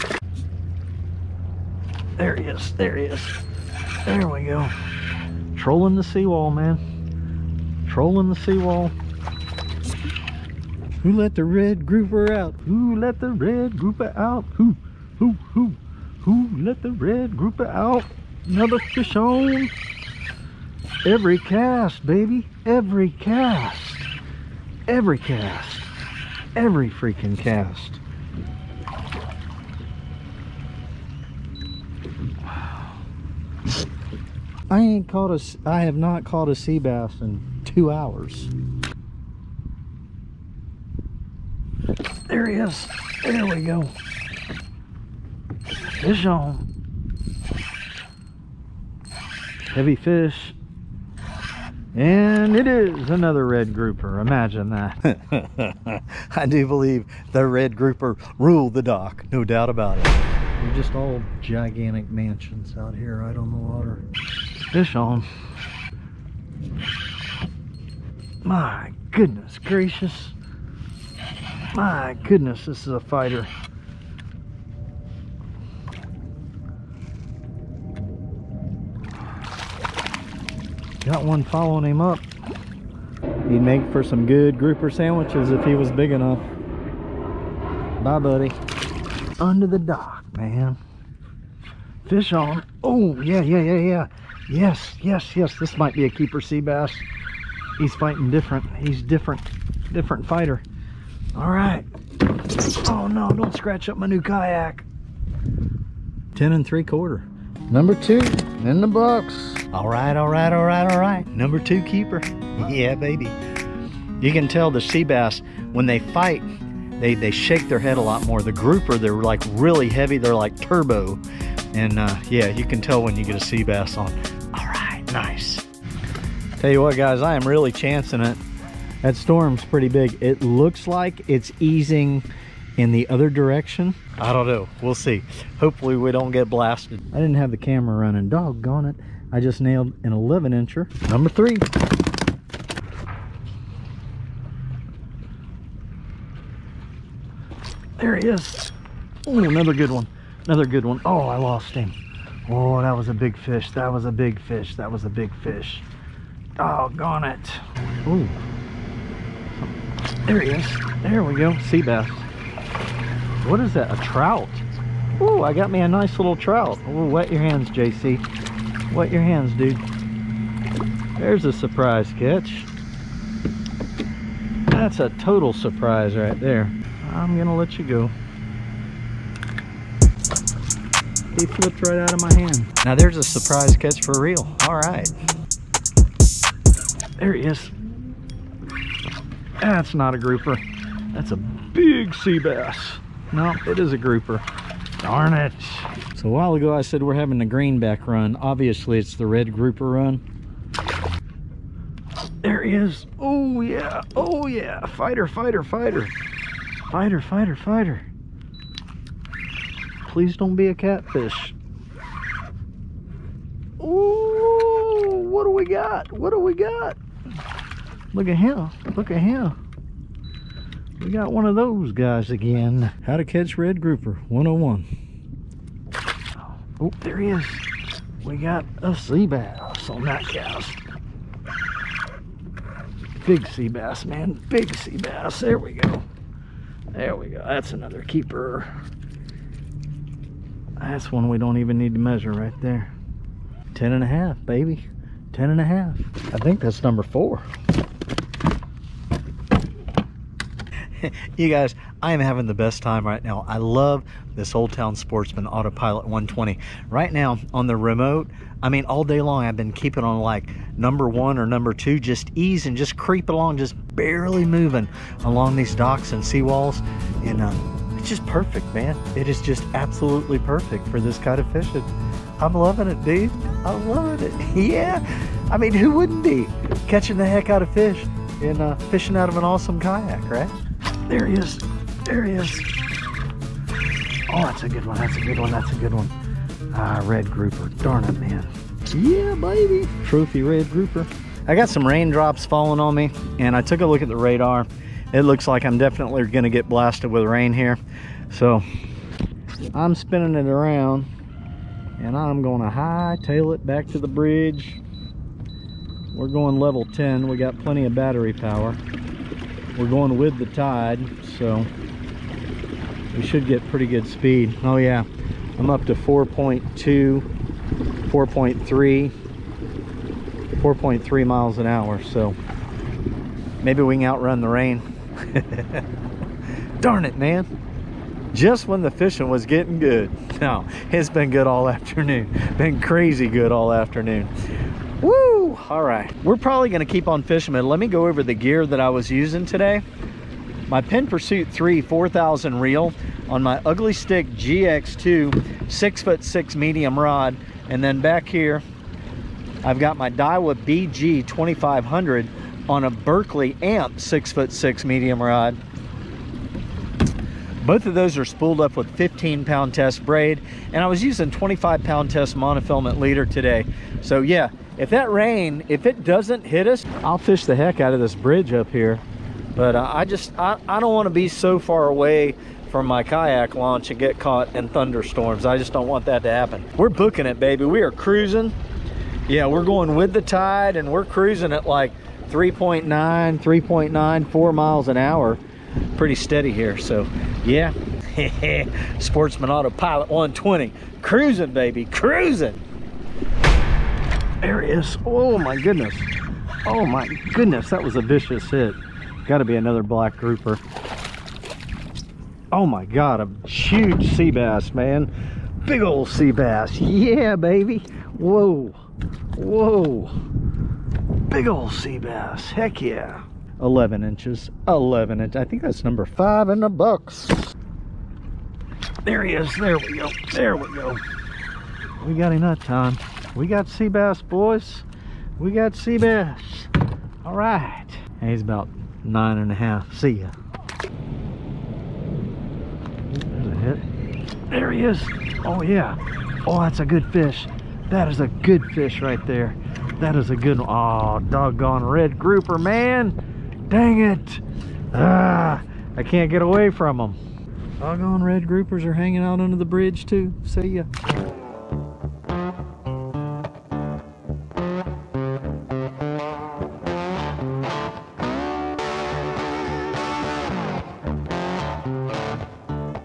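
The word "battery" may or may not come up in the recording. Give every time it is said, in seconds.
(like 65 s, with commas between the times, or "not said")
307 s.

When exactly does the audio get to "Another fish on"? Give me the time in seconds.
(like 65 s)
18 s.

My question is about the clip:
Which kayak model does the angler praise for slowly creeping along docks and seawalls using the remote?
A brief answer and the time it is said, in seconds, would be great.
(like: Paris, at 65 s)
Old Town Sportsman Autopilot 120, at 254 s.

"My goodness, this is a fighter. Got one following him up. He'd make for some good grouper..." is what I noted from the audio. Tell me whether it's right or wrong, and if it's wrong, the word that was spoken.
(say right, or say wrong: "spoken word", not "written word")
right.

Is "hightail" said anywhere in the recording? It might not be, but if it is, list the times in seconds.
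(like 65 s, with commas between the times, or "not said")
302 s.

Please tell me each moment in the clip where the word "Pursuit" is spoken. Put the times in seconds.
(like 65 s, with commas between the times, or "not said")
341 s.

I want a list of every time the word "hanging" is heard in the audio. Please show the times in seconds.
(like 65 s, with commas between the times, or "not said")
448 s.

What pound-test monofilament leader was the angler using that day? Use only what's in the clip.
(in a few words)
25 pound.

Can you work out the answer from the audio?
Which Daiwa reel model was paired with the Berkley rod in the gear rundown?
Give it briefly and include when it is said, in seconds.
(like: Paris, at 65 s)
BG 2500, at 350 s.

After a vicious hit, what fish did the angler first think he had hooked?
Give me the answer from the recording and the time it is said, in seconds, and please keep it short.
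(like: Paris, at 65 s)
Black grouper, at 399 s.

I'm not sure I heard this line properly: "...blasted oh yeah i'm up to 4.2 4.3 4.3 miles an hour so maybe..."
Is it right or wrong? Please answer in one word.
wrong.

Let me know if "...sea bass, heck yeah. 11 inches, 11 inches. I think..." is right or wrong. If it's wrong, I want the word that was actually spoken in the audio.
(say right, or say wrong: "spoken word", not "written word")
right.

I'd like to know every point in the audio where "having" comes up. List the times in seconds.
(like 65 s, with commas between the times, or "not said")
197 s, 252 s.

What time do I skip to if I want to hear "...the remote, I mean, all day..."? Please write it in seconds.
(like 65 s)
257 s.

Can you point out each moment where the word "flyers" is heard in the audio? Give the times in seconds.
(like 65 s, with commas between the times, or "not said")
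not said.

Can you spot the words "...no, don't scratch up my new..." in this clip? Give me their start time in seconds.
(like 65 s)
103 s.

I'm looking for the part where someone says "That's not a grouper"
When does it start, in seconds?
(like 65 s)
189 s.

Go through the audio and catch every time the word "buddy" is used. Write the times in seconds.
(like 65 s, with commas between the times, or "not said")
88 s.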